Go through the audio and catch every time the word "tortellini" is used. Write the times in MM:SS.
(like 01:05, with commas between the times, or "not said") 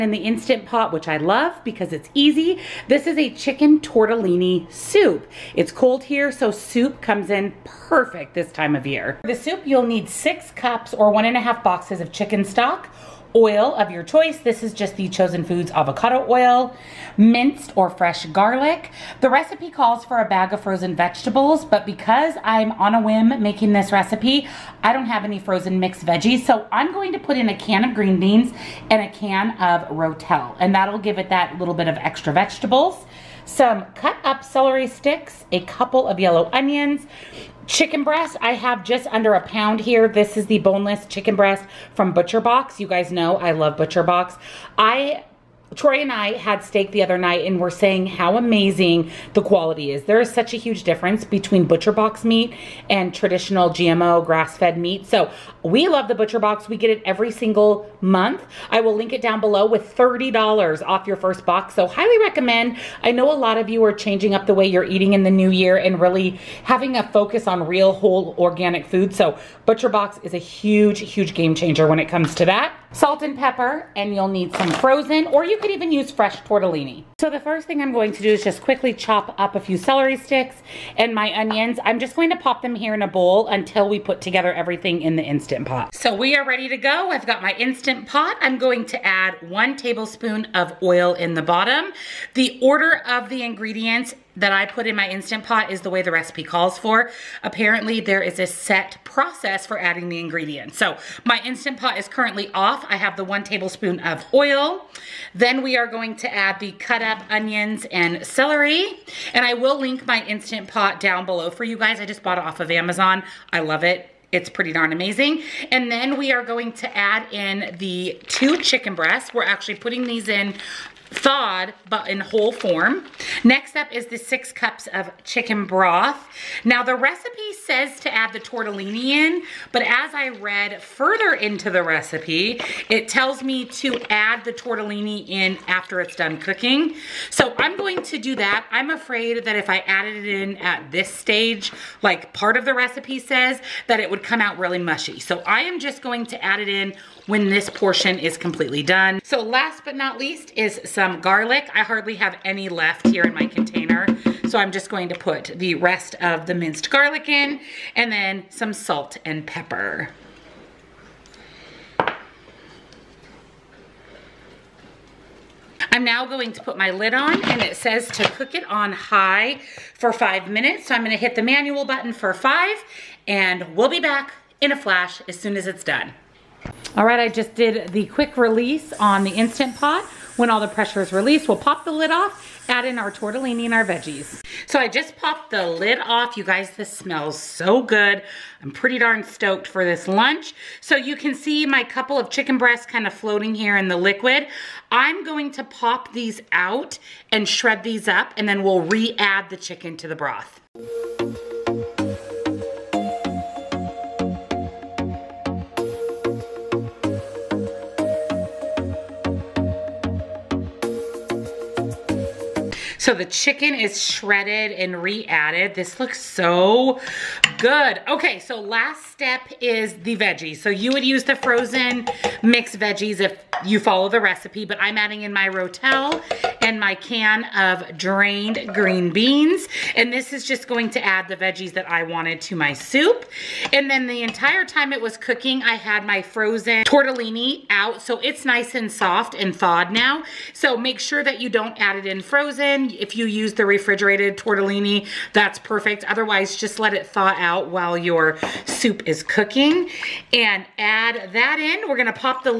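00:03, 01:16, 02:08, 02:14, 03:03, 03:56, 04:04.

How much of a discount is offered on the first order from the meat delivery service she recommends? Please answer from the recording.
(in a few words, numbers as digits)
$30.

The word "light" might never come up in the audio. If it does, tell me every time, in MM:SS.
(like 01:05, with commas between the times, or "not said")
not said.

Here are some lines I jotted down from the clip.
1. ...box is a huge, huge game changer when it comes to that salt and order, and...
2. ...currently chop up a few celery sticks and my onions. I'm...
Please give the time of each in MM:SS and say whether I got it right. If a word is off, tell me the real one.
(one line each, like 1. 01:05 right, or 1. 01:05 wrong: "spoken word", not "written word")
1. 01:09 wrong: "pepper", not "order"
2. 01:18 wrong: "quickly", not "currently".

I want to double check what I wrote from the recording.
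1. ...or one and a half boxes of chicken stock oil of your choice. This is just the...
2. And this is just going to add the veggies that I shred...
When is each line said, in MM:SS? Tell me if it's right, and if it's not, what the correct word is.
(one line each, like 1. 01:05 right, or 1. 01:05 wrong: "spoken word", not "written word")
1. 00:10 right
2. 03:49 wrong: "wanted", not "shred".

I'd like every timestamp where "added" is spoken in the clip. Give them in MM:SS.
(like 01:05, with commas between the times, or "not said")
02:19, 03:35.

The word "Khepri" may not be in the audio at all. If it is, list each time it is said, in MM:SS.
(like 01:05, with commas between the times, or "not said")
not said.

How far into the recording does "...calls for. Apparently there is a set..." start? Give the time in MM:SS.
01:36.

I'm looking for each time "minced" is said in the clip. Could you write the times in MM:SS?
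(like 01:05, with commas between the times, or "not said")
00:17, 02:36.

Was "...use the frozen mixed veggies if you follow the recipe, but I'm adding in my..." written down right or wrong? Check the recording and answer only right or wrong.
right.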